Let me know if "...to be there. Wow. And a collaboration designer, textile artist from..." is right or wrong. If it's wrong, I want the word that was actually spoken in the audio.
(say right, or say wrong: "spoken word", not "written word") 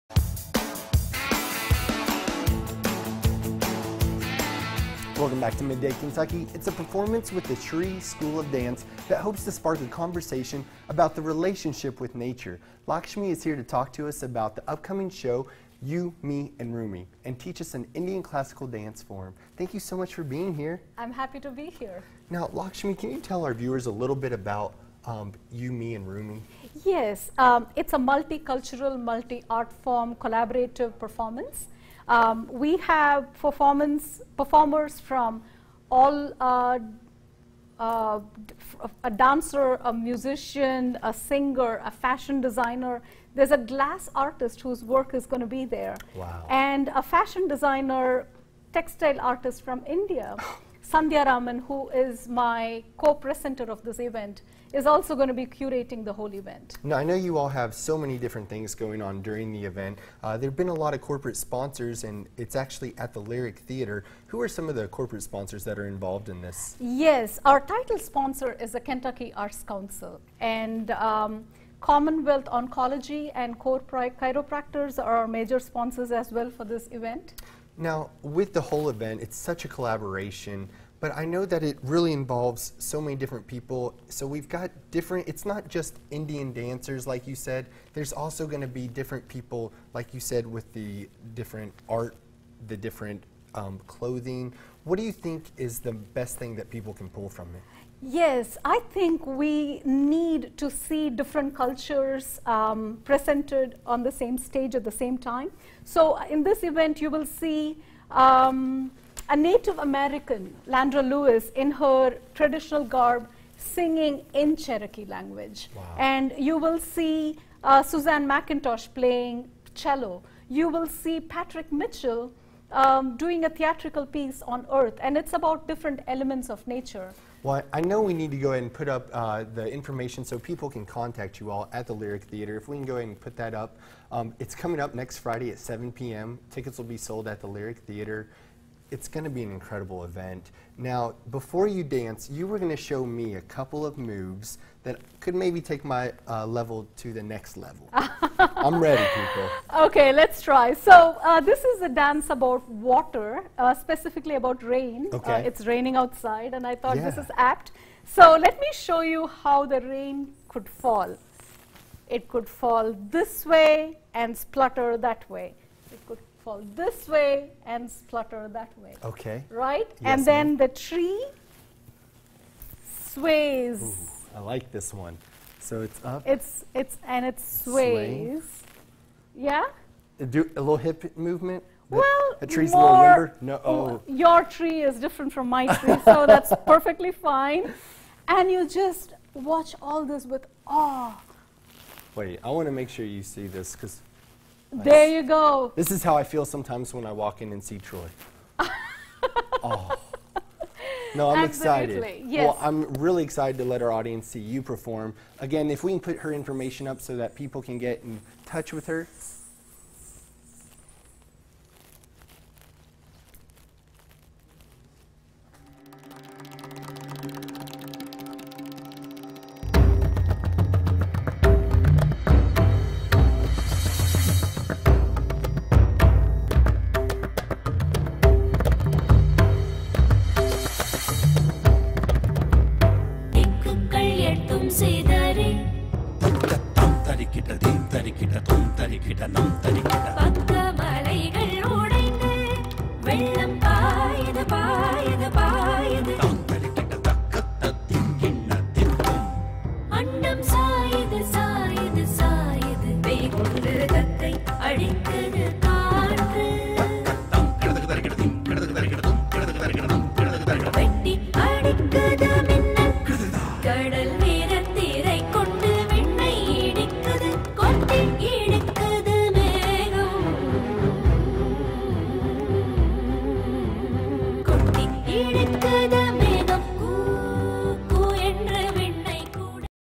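wrong: "fashion", not "collaboration".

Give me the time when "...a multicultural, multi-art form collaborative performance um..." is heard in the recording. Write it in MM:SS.
00:27.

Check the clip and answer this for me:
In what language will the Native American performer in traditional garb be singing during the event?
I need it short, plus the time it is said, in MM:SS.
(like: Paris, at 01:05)
Cherokee, at 01:54.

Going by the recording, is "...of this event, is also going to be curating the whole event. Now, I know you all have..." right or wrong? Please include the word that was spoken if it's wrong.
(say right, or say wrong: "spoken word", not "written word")
right.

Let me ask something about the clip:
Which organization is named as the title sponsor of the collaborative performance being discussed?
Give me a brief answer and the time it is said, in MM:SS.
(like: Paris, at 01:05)
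Kentucky Arts Council, at 01:08.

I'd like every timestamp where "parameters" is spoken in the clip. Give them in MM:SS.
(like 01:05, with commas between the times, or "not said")
not said.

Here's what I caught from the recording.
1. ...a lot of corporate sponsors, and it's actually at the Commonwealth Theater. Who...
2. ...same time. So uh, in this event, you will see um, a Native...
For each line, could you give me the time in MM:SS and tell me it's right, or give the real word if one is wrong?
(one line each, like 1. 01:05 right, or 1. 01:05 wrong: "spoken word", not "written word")
1. 01:00 wrong: "Lyric", not "Commonwealth"
2. 01:44 right.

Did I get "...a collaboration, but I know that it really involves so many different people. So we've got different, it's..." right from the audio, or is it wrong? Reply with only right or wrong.
right.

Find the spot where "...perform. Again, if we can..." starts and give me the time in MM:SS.
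03:24.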